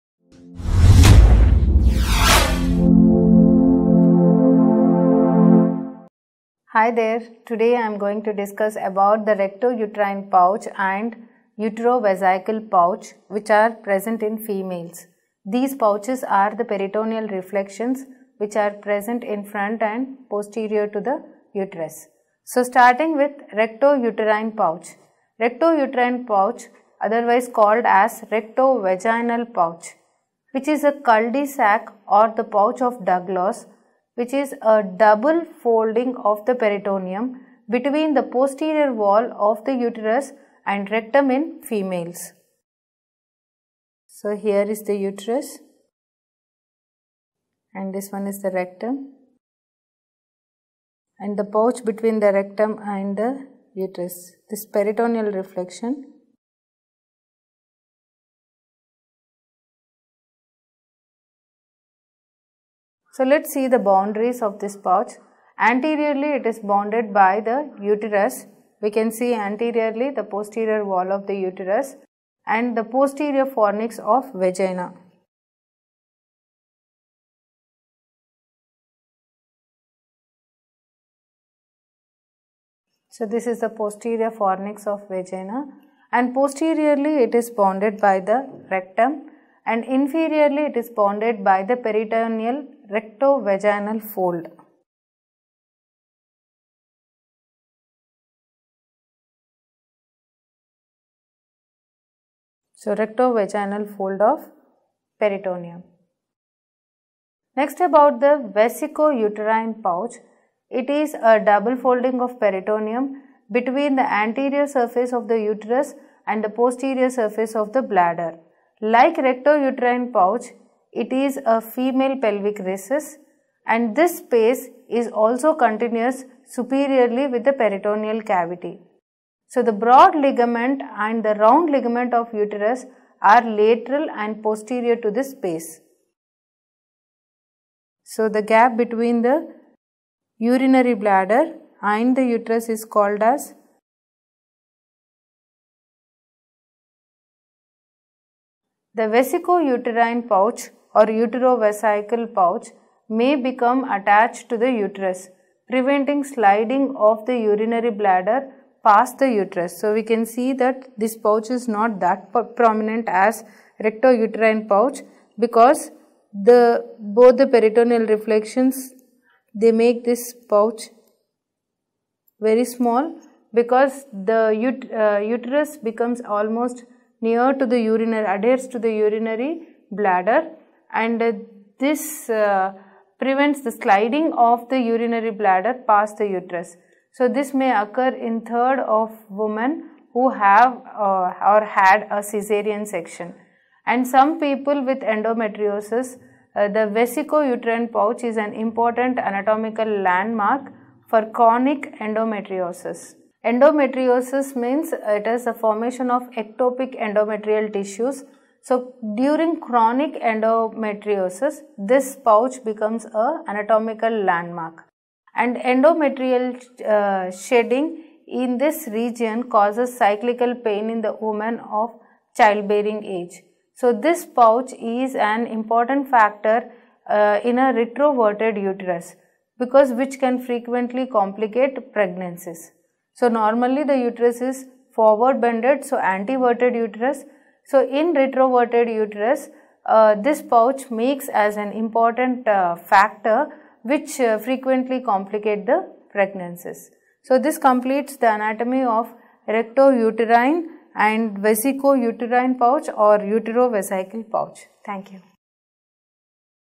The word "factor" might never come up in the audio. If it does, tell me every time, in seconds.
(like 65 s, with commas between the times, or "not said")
226 s, 242 s.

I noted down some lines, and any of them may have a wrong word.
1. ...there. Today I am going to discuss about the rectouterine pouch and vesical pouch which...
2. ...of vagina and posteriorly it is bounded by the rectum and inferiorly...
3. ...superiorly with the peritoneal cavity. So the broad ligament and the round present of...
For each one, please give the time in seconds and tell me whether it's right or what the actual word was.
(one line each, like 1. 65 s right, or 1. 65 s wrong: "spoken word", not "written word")
1. 6 s right
2. 84 s right
3. 126 s wrong: "ligament", not "present".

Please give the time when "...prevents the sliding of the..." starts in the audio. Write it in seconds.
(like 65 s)
183 s.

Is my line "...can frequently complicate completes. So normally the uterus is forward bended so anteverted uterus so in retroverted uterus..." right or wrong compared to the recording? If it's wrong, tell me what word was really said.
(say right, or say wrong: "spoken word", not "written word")
wrong: "pregnancies", not "completes".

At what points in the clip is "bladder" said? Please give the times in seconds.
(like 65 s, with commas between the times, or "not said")
117 s, 140 s, 157 s, 179 s, 185 s.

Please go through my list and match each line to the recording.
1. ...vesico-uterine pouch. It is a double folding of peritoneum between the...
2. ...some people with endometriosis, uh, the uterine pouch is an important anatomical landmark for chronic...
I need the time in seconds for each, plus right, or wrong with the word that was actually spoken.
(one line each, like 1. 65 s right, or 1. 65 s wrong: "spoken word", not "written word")
1. 108 s right
2. 194 s right.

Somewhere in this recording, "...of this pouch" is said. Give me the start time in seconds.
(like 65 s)
64 s.